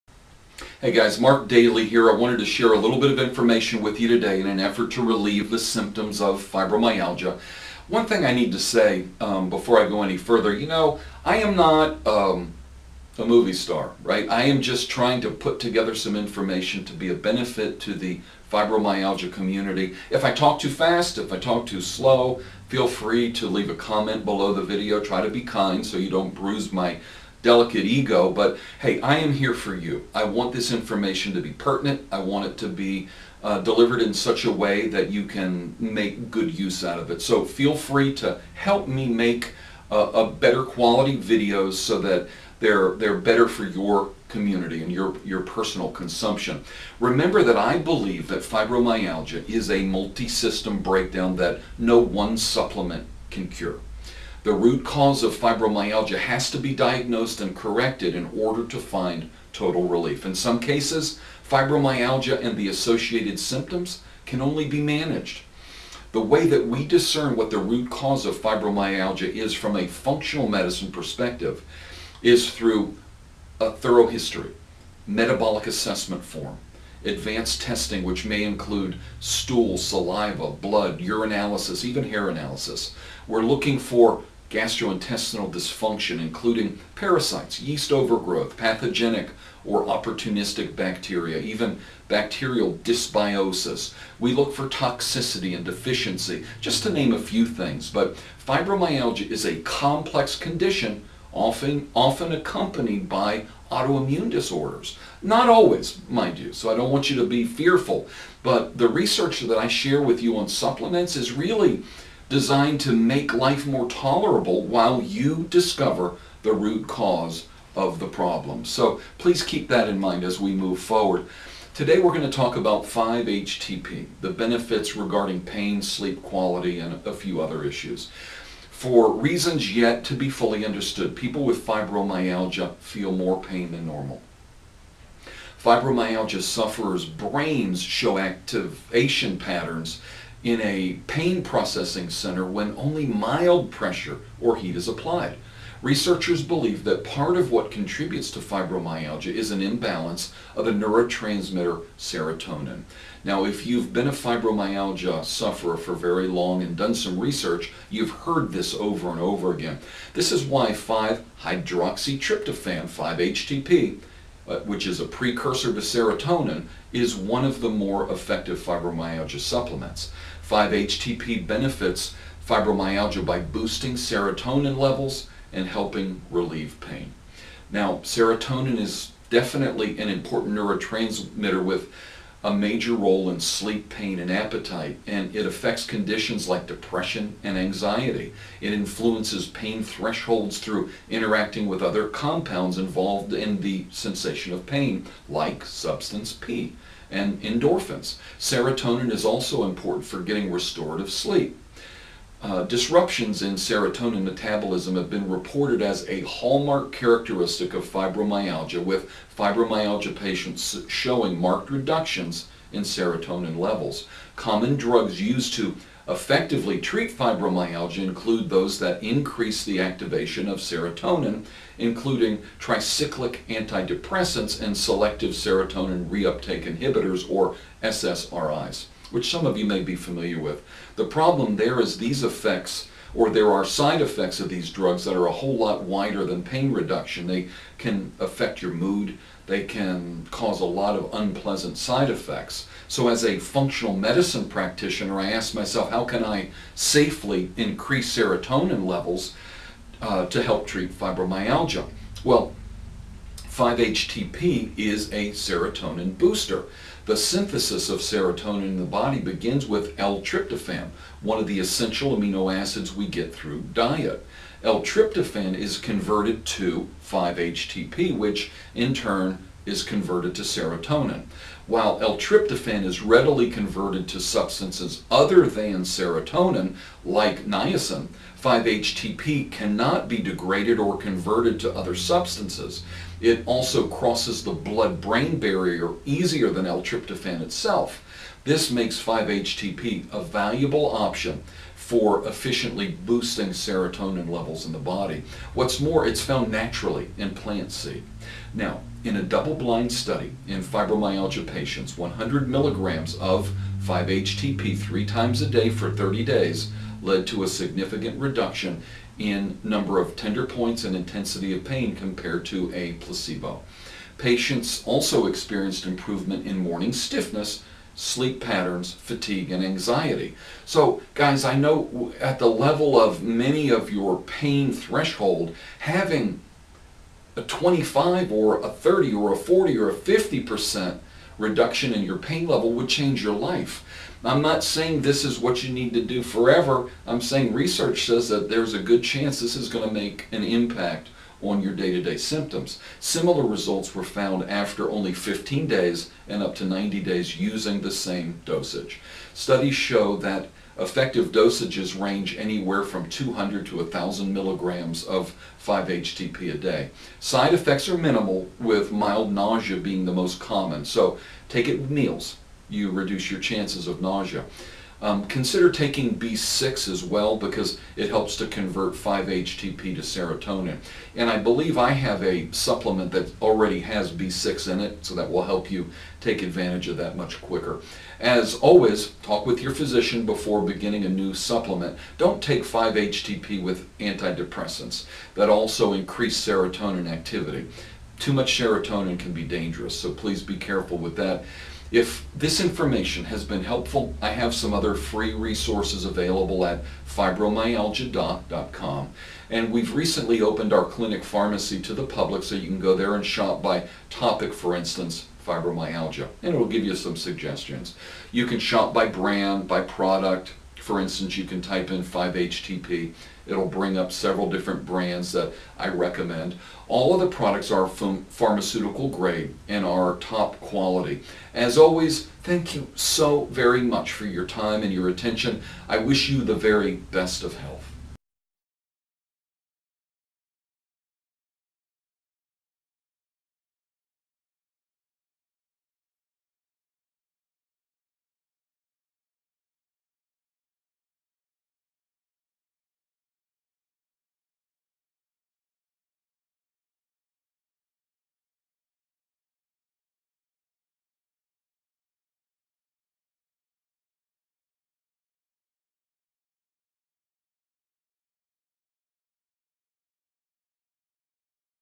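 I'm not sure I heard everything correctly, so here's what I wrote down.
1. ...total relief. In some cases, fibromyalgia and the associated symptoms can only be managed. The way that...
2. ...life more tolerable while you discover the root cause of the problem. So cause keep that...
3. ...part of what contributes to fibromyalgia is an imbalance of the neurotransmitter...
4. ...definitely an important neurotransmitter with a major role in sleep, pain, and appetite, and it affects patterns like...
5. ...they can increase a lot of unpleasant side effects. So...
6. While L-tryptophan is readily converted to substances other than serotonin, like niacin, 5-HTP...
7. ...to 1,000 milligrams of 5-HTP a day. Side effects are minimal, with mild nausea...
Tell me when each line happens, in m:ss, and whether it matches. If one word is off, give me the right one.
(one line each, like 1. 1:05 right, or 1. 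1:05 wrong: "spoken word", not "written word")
1. 0:59 right
2. 1:53 wrong: "please", not "cause"
3. 2:27 right
4. 2:59 wrong: "conditions", not "patterns"
5. 3:59 wrong: "cause", not "increase"
6. 4:31 right
7. 5:53 right.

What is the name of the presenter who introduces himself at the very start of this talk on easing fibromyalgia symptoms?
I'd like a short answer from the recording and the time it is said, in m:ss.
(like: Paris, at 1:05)
Mark Dailey, at 0:01.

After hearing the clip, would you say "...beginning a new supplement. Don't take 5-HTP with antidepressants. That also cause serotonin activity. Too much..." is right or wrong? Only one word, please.
wrong.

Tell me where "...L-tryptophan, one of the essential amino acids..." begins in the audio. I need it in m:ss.
4:19.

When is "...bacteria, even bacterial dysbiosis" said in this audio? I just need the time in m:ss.
1:30.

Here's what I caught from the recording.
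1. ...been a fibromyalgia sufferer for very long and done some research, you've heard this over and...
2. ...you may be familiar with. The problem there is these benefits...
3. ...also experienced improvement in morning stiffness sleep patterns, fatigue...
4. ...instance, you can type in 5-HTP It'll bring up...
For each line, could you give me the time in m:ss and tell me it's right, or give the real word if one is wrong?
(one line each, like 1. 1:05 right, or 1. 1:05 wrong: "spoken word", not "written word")
1. 2:33 right
2. 3:49 wrong: "effects", not "benefits"
3. 5:14 right
4. 6:51 right.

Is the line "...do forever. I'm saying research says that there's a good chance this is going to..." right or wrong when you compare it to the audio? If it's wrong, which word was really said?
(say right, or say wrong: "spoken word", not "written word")
right.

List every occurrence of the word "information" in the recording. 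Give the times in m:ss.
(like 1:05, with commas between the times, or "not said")
0:03, 0:16, 0:30, 6:32.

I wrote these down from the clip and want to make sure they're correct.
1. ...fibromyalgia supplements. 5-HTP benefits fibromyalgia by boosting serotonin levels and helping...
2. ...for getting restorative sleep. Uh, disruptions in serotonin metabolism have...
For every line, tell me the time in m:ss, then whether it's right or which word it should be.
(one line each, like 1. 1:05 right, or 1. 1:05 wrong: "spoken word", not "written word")
1. 2:48 right
2. 3:20 right.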